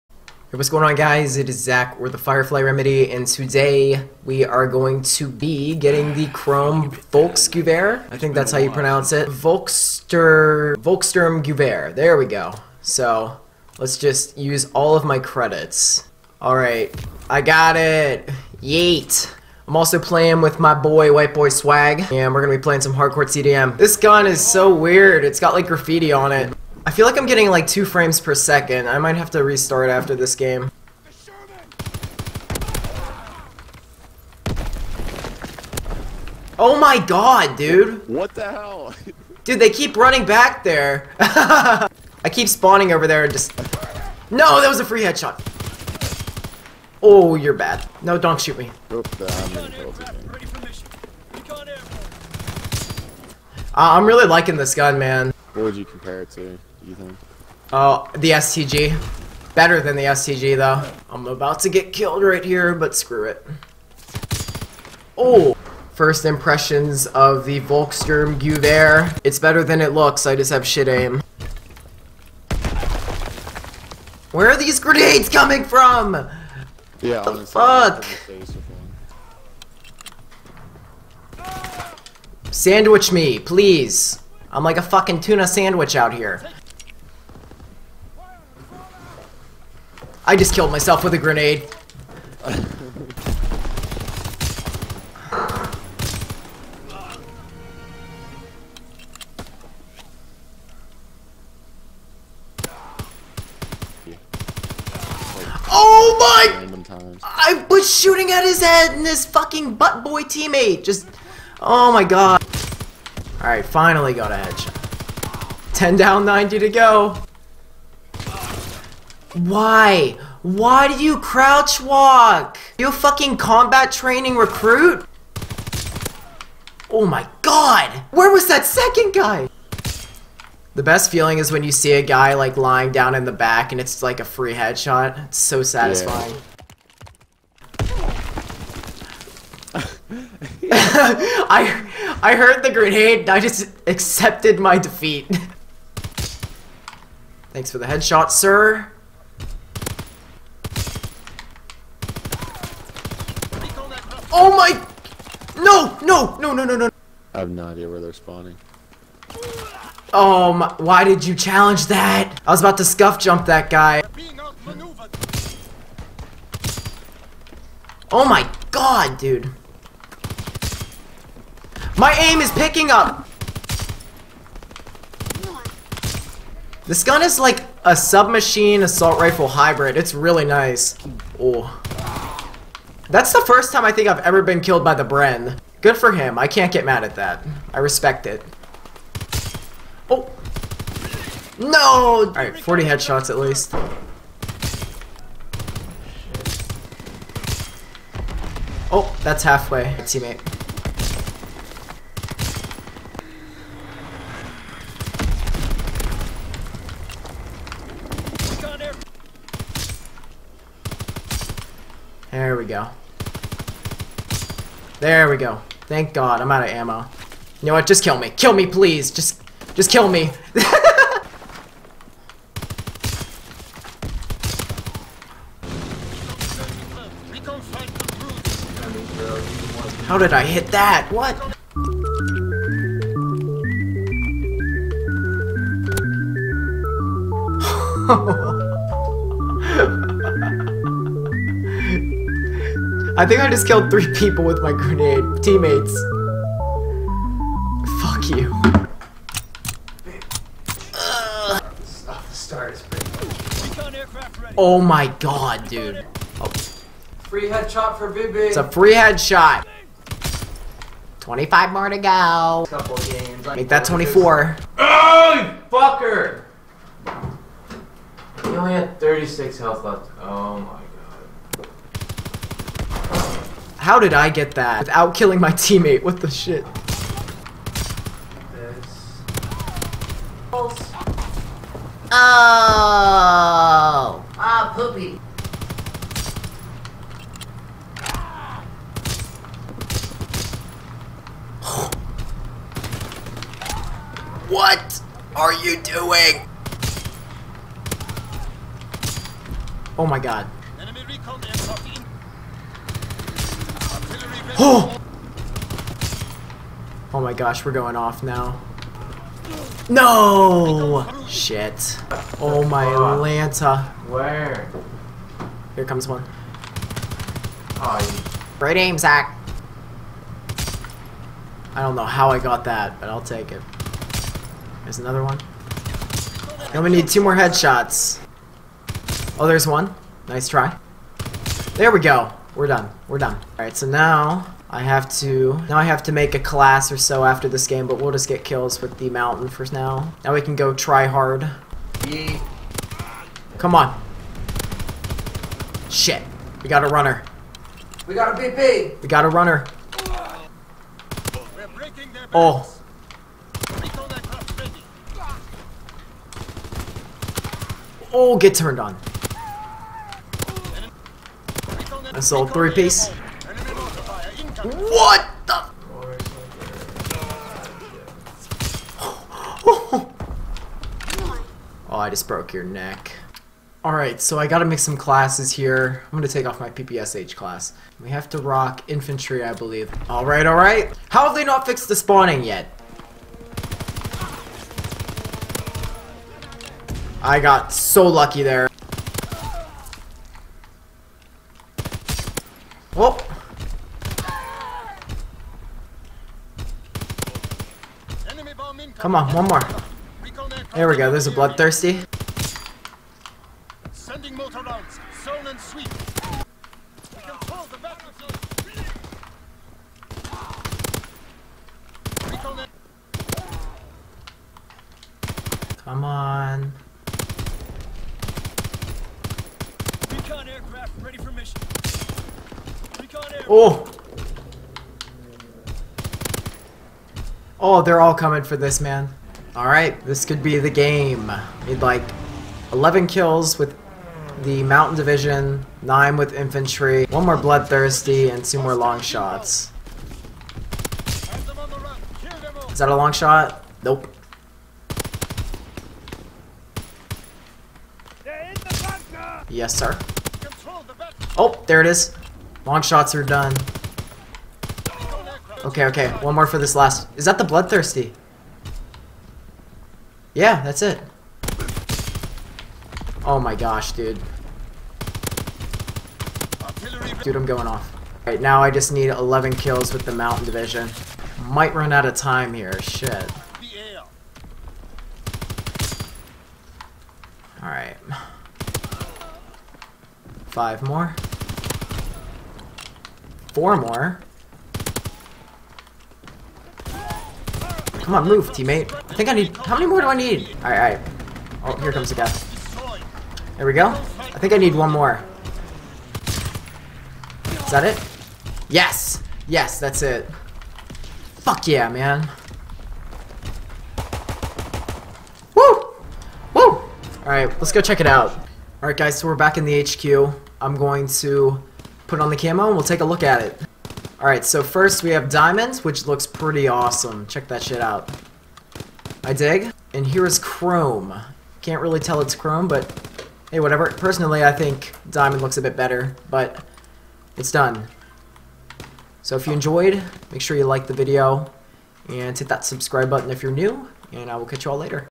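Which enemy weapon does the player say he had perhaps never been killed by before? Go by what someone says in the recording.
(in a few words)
Bren.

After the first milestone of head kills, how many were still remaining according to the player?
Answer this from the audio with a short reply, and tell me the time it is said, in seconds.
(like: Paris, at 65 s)
90, at 116 s.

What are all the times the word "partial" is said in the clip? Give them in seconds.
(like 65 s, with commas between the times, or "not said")
not said.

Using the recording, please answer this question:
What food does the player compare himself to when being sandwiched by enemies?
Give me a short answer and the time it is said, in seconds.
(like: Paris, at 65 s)
tuna sandwich, at 85 s.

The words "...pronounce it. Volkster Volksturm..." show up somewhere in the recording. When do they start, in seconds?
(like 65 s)
8 s.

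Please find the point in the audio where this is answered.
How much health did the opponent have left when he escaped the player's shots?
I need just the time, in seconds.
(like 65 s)
268 s.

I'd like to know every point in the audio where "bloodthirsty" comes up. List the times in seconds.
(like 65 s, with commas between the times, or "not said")
401 s, 437 s, 457 s.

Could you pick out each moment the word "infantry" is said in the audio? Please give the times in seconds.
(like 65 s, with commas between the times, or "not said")
378 s, 436 s.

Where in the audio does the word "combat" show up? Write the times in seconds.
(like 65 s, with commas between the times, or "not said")
123 s.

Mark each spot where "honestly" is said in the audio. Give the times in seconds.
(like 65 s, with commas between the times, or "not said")
77 s.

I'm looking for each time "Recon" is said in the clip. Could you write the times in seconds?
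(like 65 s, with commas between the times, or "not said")
420 s.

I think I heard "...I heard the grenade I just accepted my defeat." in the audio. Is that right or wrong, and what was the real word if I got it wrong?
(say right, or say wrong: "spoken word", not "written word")
right.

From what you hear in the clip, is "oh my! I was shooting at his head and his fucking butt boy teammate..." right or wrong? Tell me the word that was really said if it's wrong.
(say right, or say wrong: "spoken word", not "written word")
right.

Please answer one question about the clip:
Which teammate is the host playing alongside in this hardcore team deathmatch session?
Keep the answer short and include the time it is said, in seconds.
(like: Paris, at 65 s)
White Boy Swag, at 21 s.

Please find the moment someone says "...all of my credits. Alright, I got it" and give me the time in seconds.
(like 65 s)
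14 s.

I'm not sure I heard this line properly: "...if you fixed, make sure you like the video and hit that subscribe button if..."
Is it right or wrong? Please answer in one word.
wrong.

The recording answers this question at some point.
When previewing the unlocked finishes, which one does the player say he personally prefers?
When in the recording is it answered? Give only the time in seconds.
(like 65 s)
525 s.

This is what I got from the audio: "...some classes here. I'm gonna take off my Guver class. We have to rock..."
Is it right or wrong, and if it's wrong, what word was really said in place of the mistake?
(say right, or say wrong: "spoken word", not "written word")
wrong: "PPSH", not "Guver".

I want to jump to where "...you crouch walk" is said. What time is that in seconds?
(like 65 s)
121 s.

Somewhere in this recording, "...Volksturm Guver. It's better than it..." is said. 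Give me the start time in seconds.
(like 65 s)
67 s.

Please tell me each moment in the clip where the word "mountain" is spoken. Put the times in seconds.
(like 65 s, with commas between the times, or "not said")
339 s, 434 s, 470 s.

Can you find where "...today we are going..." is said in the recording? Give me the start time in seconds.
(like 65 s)
3 s.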